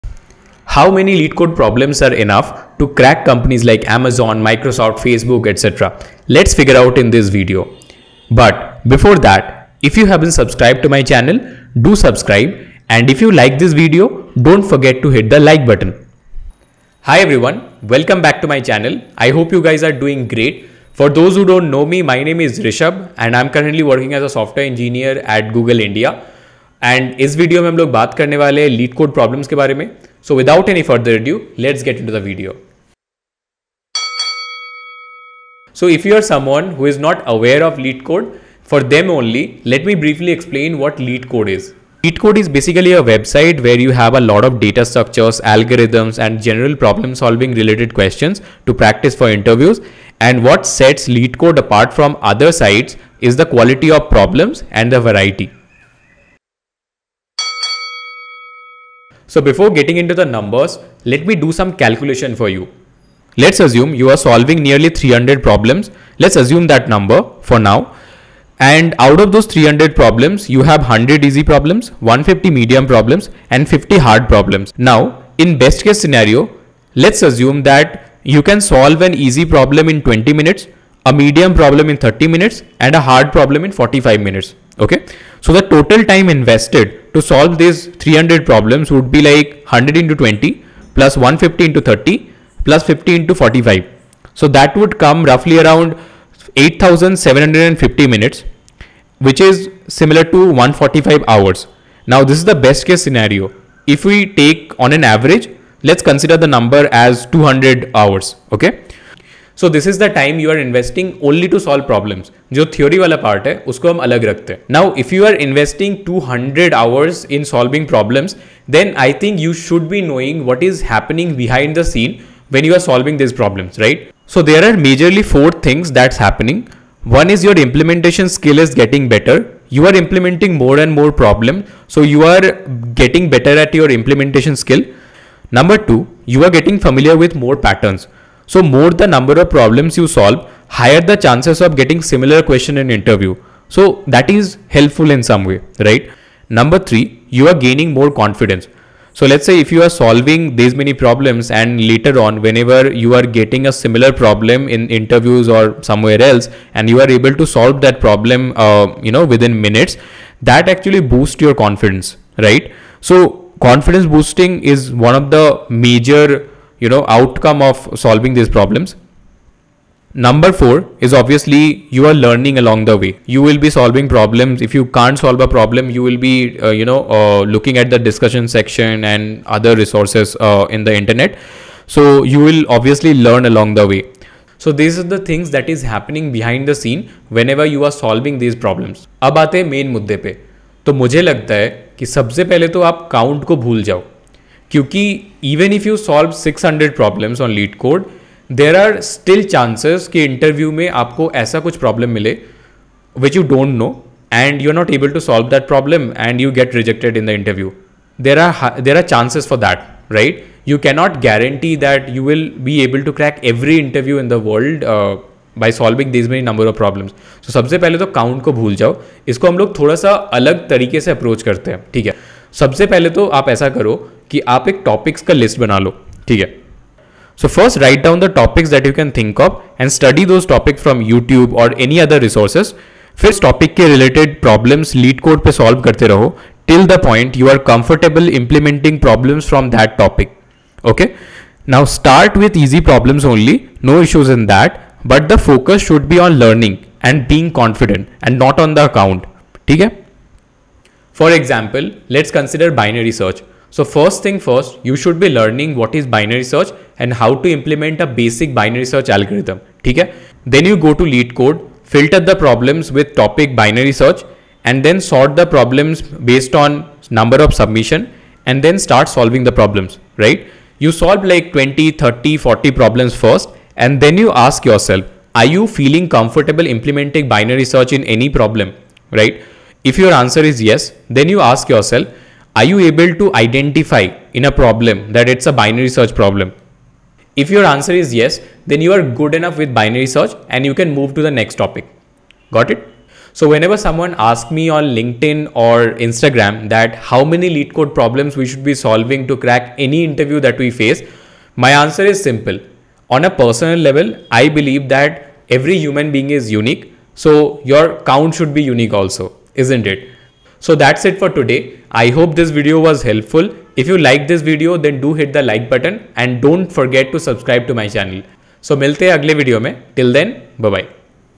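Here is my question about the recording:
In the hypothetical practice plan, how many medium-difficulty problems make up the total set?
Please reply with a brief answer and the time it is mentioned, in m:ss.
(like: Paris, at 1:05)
150, at 1:12.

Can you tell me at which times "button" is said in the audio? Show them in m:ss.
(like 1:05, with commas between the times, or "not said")
0:15, 5:15.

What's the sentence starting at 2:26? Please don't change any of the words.
Number three, you are gaining more confidence.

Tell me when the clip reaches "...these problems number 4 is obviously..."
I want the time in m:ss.
2:48.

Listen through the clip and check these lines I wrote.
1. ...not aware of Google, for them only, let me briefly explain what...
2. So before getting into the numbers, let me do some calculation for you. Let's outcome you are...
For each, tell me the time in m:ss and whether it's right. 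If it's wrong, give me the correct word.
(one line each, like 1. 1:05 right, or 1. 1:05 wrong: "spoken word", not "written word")
1. 0:36 wrong: "LeetCode", not "Google"
2. 0:59 wrong: "assume", not "outcome".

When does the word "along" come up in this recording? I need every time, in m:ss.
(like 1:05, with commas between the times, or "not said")
2:52, 3:03.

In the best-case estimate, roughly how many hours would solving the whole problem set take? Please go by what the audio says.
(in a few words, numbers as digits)
145 hours.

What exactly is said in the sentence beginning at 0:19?
I hope you guys are doing great.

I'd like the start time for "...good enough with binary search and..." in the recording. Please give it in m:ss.
4:49.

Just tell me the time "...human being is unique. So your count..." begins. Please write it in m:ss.
5:05.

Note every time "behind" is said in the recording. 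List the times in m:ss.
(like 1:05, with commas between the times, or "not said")
2:01, 3:06.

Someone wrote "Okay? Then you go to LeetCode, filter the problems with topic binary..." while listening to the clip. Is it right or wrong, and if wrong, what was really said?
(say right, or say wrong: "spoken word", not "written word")
right.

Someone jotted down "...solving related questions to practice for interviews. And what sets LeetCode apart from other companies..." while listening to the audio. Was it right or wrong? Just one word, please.
wrong.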